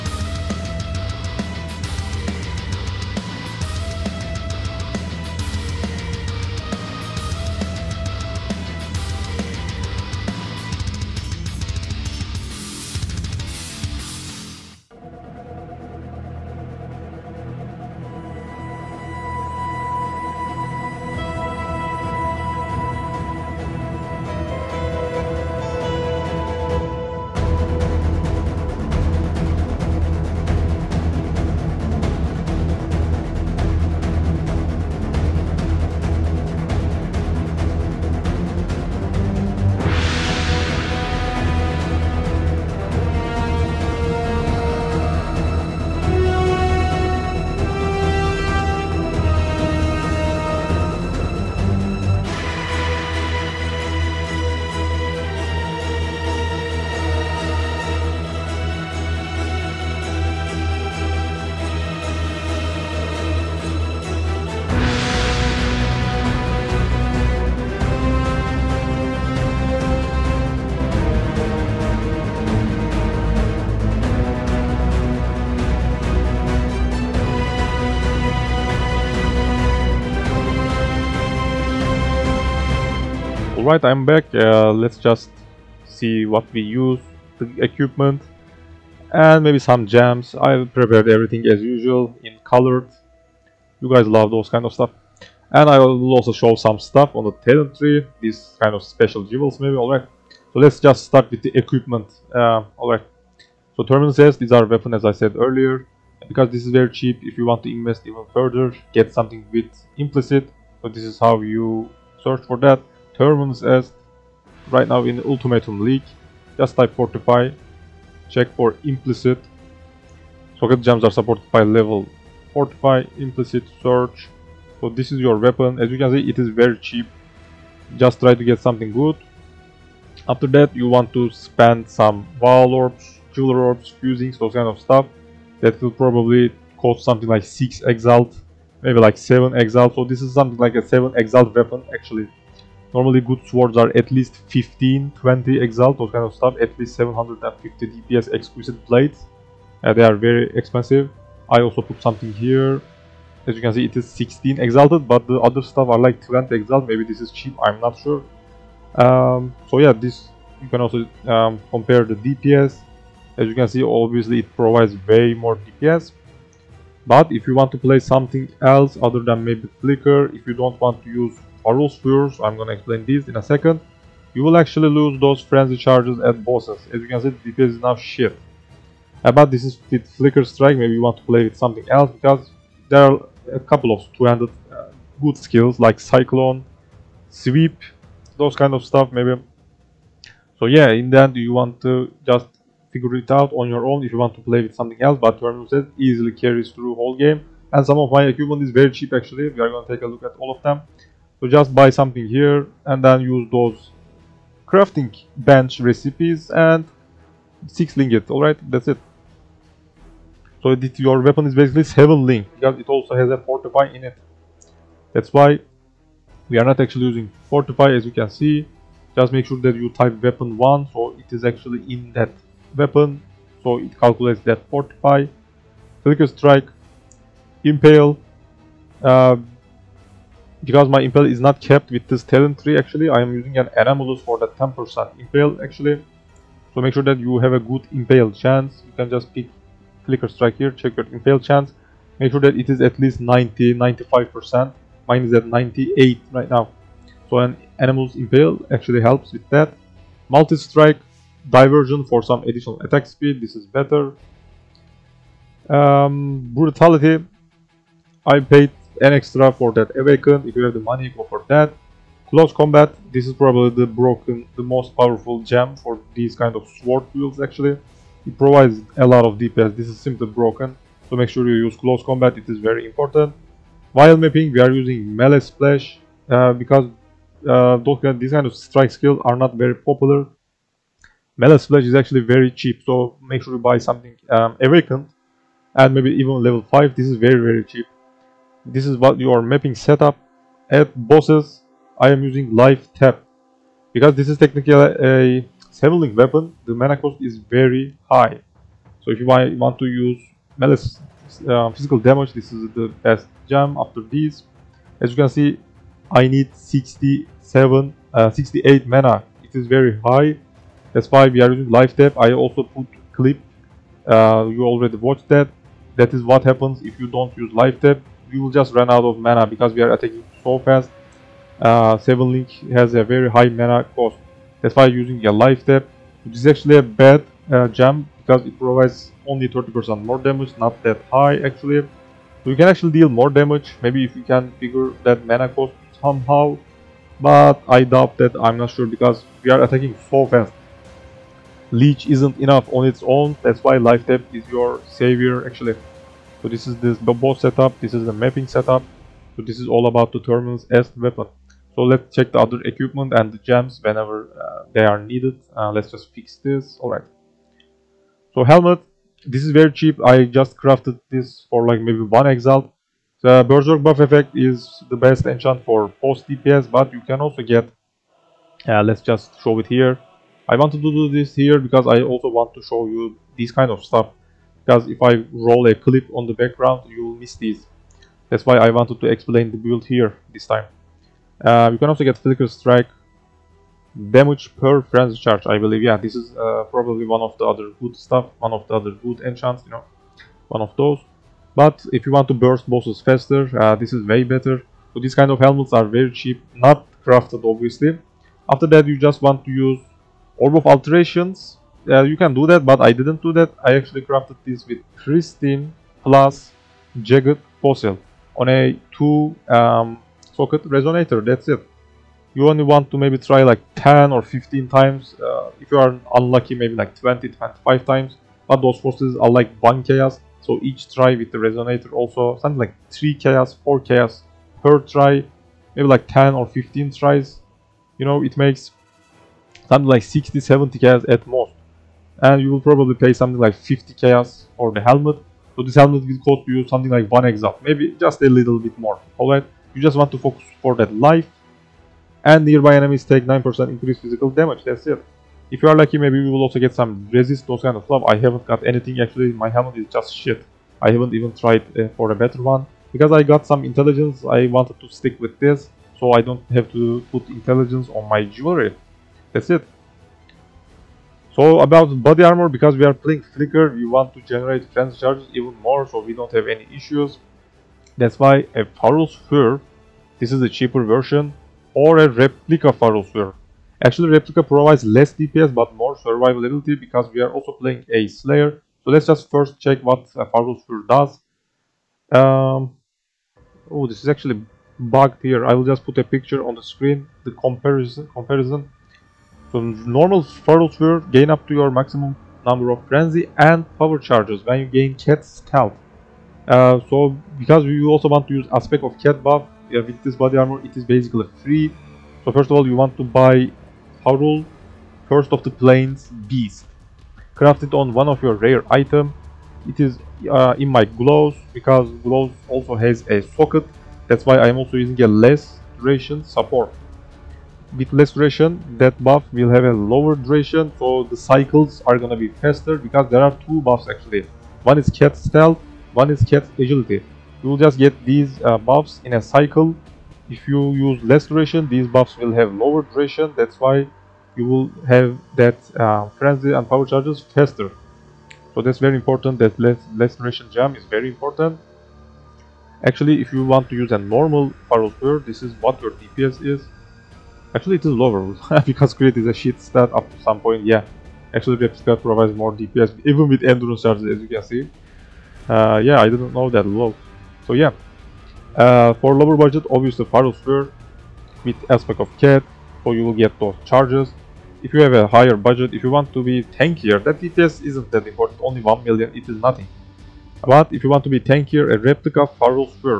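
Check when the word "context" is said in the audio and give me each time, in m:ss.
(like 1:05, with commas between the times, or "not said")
not said.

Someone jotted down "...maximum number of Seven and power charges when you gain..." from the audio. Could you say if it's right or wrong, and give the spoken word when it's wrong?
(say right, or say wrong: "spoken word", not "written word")
wrong: "Frenzy", not "Seven".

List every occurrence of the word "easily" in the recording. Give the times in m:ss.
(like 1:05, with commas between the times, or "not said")
3:15.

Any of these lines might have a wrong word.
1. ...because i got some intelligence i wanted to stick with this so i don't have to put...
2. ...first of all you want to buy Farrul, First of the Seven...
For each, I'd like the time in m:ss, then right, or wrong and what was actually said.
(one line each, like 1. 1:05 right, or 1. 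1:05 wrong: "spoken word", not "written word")
1. 7:32 right
2. 8:22 wrong: "Plains", not "Seven".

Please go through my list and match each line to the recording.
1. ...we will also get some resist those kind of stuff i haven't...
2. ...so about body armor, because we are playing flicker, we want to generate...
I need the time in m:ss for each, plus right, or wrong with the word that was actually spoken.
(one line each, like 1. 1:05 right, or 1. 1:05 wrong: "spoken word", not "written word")
1. 7:26 right
2. 7:41 right.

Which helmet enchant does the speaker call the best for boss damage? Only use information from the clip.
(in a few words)
Berserk buff effect.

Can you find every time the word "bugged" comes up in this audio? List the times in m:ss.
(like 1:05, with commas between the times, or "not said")
8:04.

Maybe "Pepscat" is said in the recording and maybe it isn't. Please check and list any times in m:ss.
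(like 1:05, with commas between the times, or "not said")
9:11.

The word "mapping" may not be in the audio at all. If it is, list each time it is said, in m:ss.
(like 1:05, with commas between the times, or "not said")
4:34, 4:49, 5:48.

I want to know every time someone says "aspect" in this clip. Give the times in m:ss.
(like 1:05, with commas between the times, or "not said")
8:18, 9:21.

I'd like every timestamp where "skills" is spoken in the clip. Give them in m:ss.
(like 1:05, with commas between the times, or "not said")
3:05, 4:38.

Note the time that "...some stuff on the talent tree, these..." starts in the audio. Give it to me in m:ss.
1:36.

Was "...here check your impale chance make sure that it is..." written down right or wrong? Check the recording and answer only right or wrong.
right.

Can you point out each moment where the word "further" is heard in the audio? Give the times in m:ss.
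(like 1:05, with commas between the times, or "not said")
1:48.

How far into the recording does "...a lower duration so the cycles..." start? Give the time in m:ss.
8:39.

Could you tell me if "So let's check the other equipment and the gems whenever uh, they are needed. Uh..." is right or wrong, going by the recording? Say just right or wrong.
right.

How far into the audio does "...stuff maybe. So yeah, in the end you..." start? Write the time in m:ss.
3:08.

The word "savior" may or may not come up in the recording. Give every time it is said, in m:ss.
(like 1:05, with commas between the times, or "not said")
5:44.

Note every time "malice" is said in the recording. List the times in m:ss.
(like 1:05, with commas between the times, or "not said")
5:00.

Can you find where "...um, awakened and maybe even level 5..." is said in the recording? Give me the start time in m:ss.
4:44.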